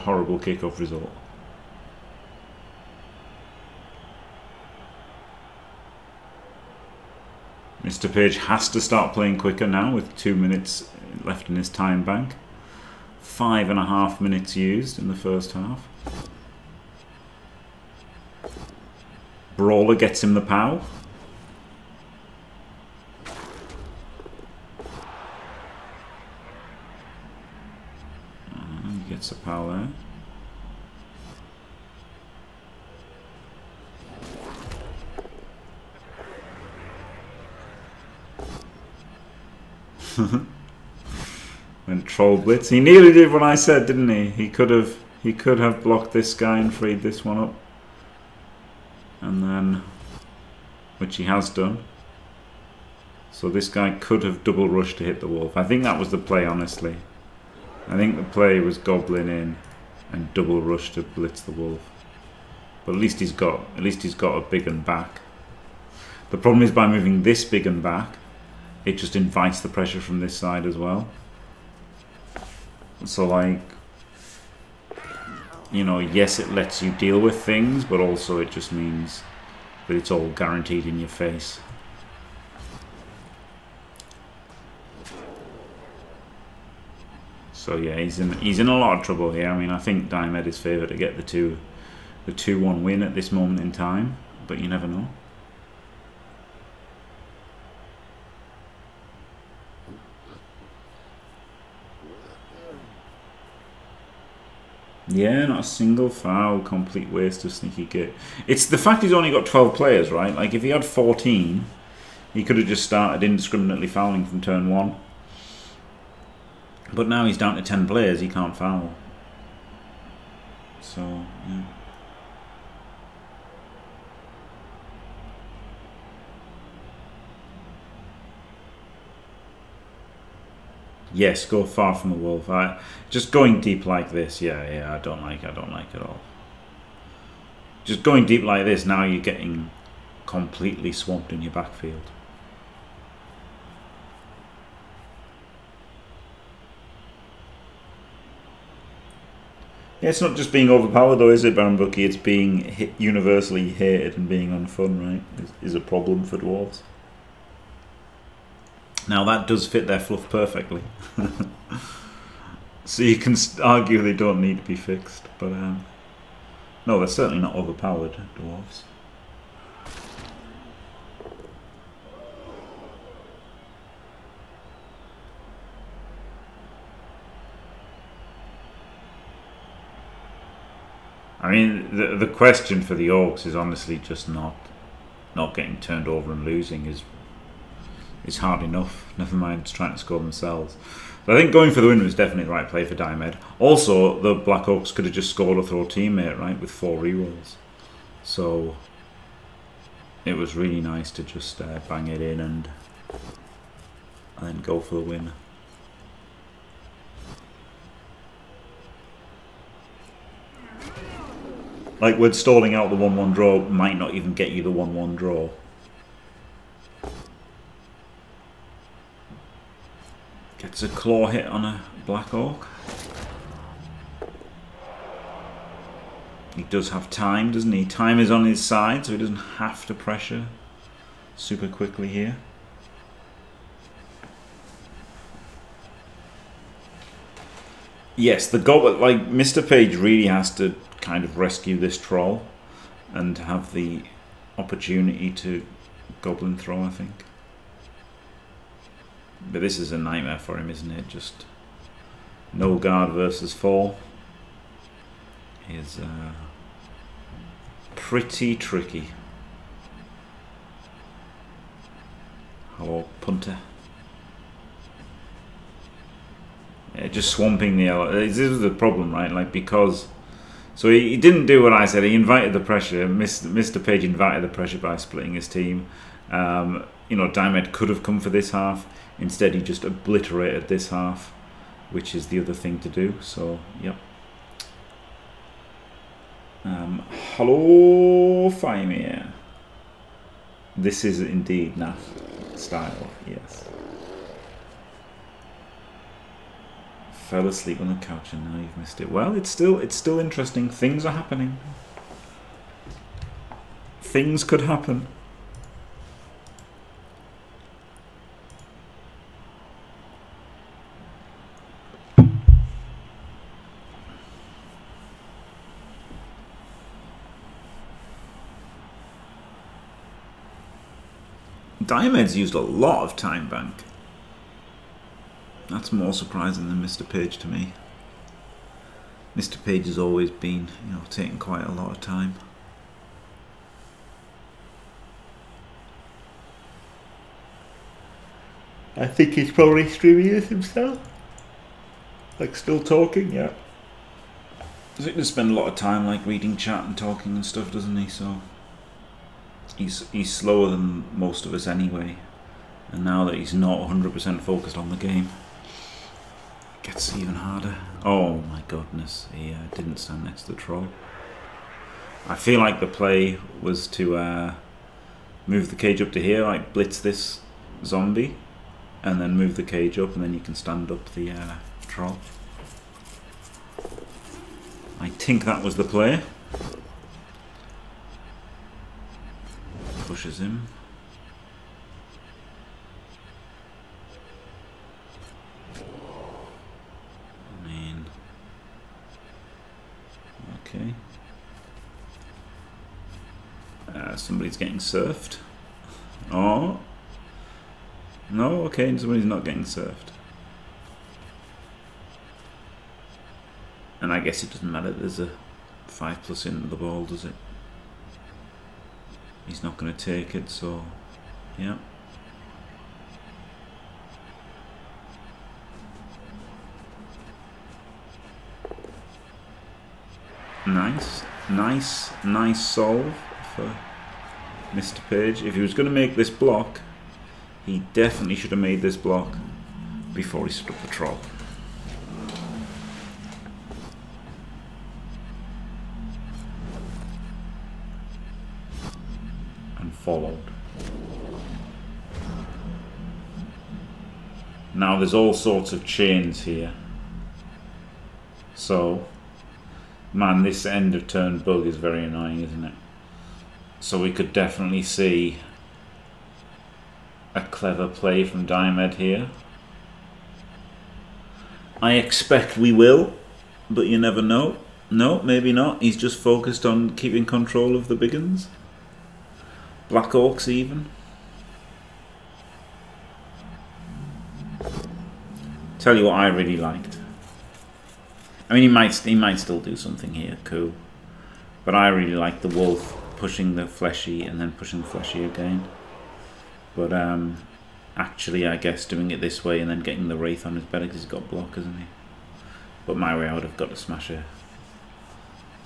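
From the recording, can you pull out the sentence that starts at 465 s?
He's just focused on keeping control of the big Black Orcs even.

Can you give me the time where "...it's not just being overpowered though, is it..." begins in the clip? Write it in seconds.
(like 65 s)
150 s.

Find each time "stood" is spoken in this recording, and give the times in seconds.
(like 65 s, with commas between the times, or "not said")
430 s.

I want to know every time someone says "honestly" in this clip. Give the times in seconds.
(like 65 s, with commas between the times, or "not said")
56 s, 183 s.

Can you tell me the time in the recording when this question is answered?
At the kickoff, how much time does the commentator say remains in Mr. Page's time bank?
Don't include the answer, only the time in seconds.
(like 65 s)
10 s.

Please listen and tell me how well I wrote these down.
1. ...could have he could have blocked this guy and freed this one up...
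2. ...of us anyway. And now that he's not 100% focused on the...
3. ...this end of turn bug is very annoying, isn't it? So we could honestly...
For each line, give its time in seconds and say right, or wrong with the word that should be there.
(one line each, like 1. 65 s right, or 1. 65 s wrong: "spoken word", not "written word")
1. 44 s right
2. 351 s right
3. 450 s wrong: "definitely", not "honestly".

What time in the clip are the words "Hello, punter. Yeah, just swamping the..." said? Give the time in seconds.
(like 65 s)
262 s.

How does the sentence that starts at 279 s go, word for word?
Instead, he just obliterated this half, which is the other thing to do.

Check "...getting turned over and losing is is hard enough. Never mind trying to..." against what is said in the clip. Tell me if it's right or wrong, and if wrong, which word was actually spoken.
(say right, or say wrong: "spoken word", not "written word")
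right.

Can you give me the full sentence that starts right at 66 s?
The problem is by moving this big and back, it just invites the pressure from this side as well.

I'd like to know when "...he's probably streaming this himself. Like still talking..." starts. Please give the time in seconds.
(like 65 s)
339 s.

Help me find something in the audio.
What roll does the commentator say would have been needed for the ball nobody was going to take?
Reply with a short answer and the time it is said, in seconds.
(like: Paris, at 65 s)
5+, at 405 s.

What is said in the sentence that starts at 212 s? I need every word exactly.
Like, with stalling out the 1-1 draw might not even get you the 1-1 draw.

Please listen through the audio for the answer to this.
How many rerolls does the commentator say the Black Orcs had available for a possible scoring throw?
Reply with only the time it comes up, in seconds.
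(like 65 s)
196 s.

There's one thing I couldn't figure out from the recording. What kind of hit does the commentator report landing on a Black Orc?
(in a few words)
Claw hit.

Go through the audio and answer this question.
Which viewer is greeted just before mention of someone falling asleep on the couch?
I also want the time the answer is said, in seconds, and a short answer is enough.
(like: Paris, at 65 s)
Fymir, at 288 s.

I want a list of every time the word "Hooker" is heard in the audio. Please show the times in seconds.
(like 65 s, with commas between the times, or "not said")
not said.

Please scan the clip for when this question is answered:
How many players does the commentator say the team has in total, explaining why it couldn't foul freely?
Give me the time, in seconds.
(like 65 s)
109 s.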